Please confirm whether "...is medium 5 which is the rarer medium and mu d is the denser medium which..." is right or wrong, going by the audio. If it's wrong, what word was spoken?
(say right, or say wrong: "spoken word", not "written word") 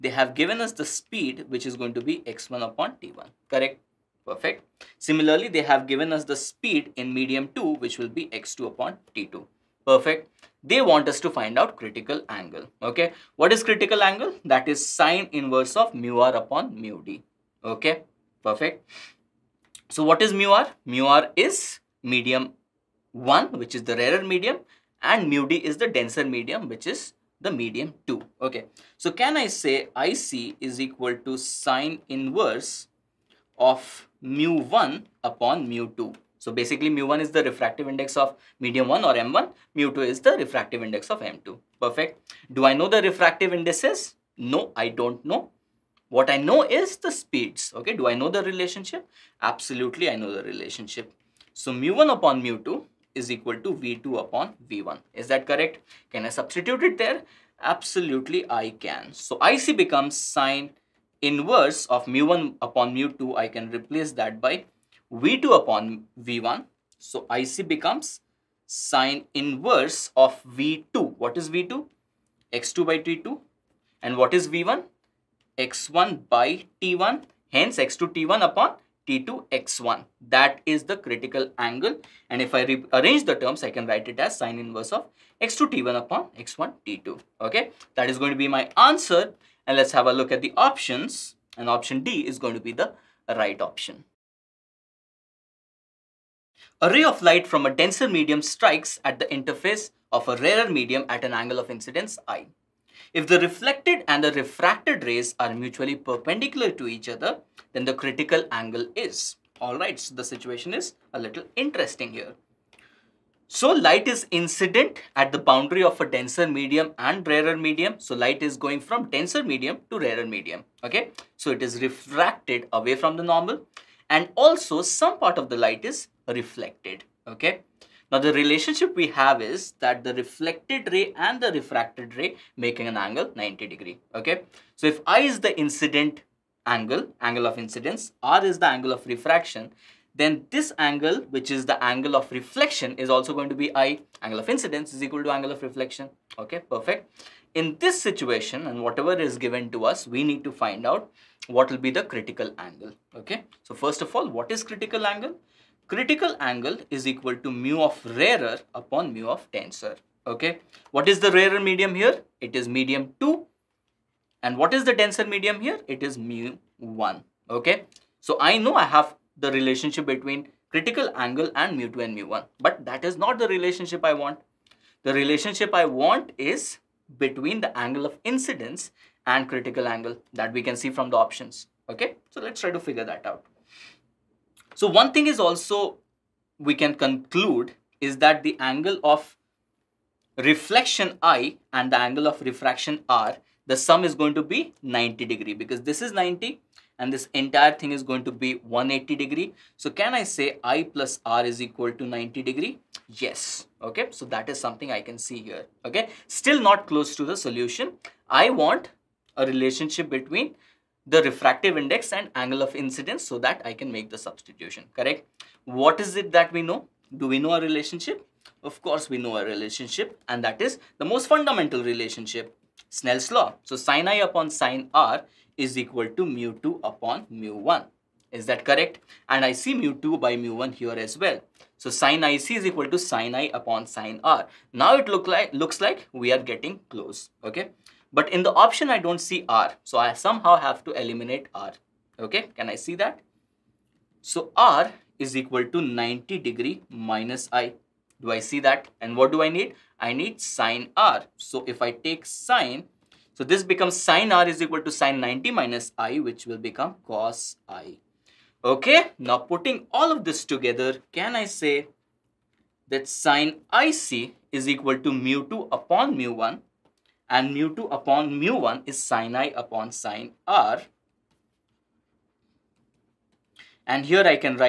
wrong: "1", not "5".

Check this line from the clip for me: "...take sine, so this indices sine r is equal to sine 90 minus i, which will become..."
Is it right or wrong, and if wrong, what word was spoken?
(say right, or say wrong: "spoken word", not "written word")
wrong: "becomes", not "indices".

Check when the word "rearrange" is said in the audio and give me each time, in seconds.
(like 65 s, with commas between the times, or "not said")
82 s.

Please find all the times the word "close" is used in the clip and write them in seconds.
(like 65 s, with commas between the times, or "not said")
206 s, 236 s.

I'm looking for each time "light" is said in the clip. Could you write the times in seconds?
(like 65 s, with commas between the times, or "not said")
97 s, 113 s, 118 s, 125 s.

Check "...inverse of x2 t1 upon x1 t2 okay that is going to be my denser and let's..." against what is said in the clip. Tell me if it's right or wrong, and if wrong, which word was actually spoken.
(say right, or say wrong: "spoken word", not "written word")
wrong: "answer", not "denser".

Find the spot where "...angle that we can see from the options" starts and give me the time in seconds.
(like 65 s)
179 s.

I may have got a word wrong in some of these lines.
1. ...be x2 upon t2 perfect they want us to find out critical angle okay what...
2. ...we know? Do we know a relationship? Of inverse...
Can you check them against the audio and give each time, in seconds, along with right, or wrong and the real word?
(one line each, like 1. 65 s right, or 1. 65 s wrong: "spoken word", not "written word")
1. 8 s right
2. 216 s wrong: "course", not "inverse".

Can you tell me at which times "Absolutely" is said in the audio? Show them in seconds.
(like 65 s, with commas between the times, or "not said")
49 s, 57 s.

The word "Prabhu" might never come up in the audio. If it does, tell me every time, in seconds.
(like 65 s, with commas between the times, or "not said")
not said.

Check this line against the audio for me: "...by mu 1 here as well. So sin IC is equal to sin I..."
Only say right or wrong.
right.